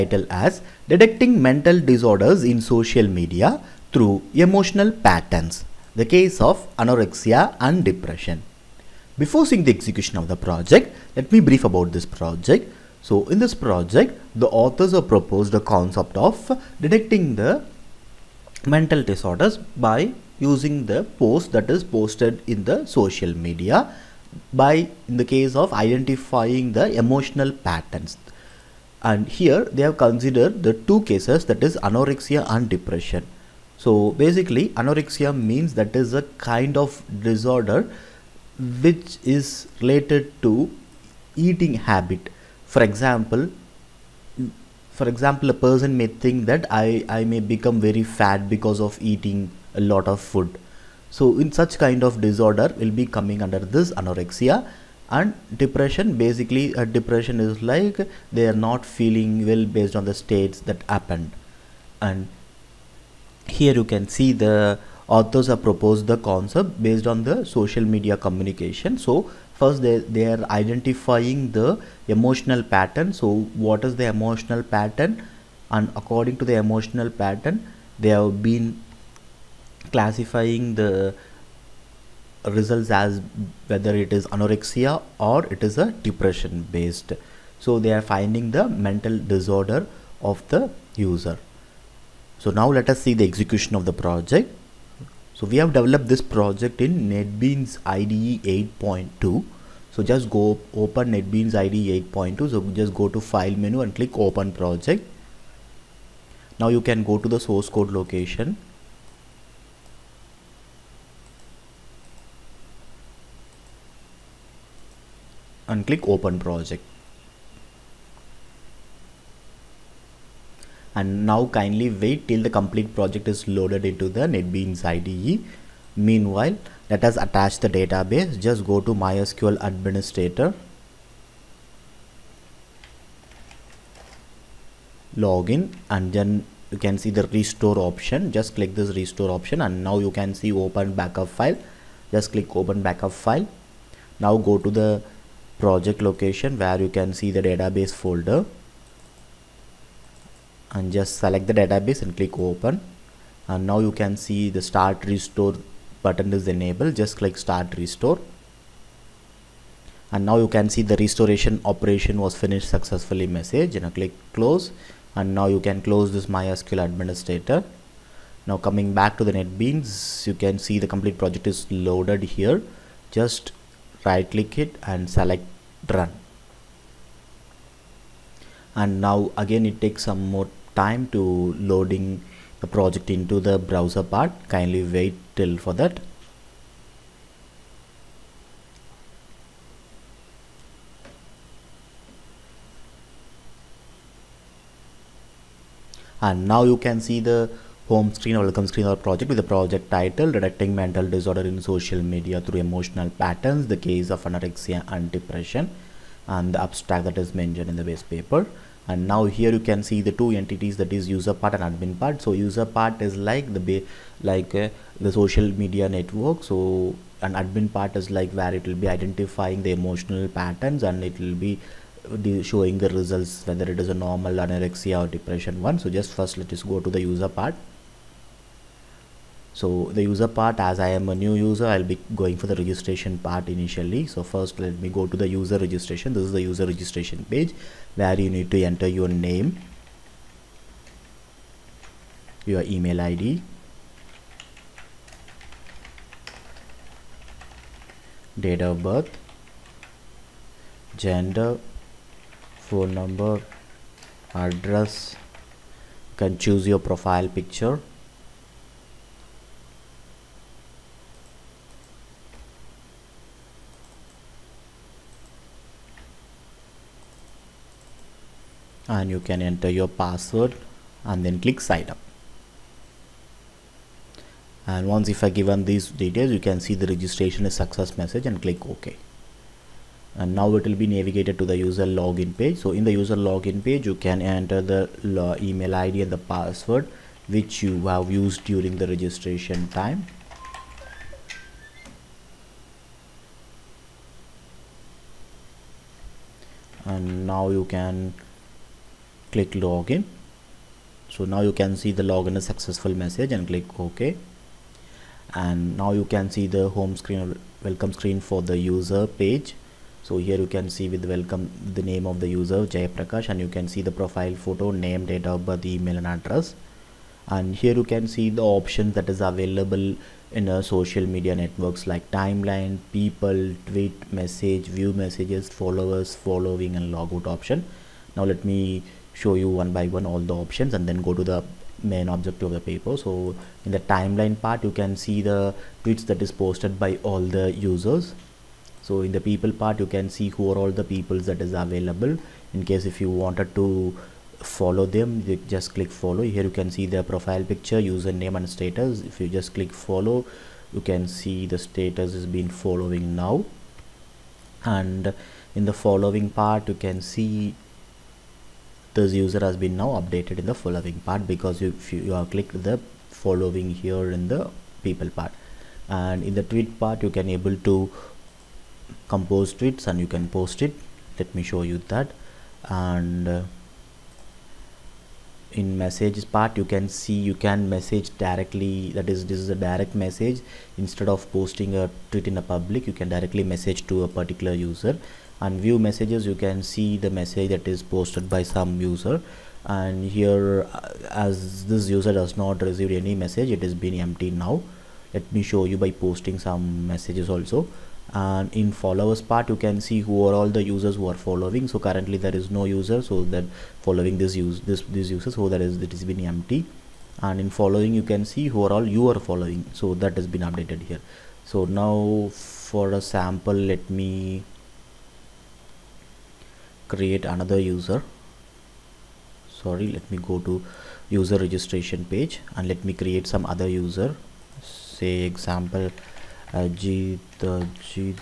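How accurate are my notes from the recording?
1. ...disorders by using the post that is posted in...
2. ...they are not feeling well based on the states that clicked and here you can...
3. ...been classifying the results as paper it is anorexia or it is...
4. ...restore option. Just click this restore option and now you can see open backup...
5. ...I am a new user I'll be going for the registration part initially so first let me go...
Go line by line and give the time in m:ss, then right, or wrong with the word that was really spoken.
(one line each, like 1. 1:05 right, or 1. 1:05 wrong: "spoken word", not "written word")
1. 0:19 right
2. 0:58 wrong: "happened", not "clicked"
3. 1:18 wrong: "whether", not "paper"
4. 2:17 right
5. 3:50 right.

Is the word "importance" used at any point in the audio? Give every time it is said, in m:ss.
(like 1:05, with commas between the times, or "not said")
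not said.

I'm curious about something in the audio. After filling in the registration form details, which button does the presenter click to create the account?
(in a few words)
sign up.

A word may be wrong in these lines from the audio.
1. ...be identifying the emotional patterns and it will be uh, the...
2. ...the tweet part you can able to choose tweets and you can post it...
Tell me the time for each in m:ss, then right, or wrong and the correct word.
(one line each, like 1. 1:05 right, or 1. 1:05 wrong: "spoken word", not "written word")
1. 3:38 right
2. 6:06 wrong: "compose", not "choose".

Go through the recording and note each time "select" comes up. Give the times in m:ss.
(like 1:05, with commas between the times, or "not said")
2:31, 2:55.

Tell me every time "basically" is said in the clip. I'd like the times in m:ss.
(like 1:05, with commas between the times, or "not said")
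0:34, 0:56.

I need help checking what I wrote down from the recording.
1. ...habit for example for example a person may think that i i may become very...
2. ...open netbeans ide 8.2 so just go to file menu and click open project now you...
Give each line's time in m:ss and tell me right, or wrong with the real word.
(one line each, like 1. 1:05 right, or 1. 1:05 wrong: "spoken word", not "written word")
1. 0:41 right
2. 1:40 right.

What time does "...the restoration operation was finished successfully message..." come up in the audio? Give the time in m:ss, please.
2:40.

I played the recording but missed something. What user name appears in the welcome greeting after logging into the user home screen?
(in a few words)
Jayaprakash.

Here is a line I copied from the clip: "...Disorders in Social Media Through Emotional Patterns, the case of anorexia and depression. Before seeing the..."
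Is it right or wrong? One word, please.
right.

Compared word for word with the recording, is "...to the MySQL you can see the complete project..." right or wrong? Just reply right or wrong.
wrong.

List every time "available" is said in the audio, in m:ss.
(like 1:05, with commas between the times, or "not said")
5:19, 5:41.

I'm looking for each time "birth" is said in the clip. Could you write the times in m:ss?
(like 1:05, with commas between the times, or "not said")
4:08, 5:15.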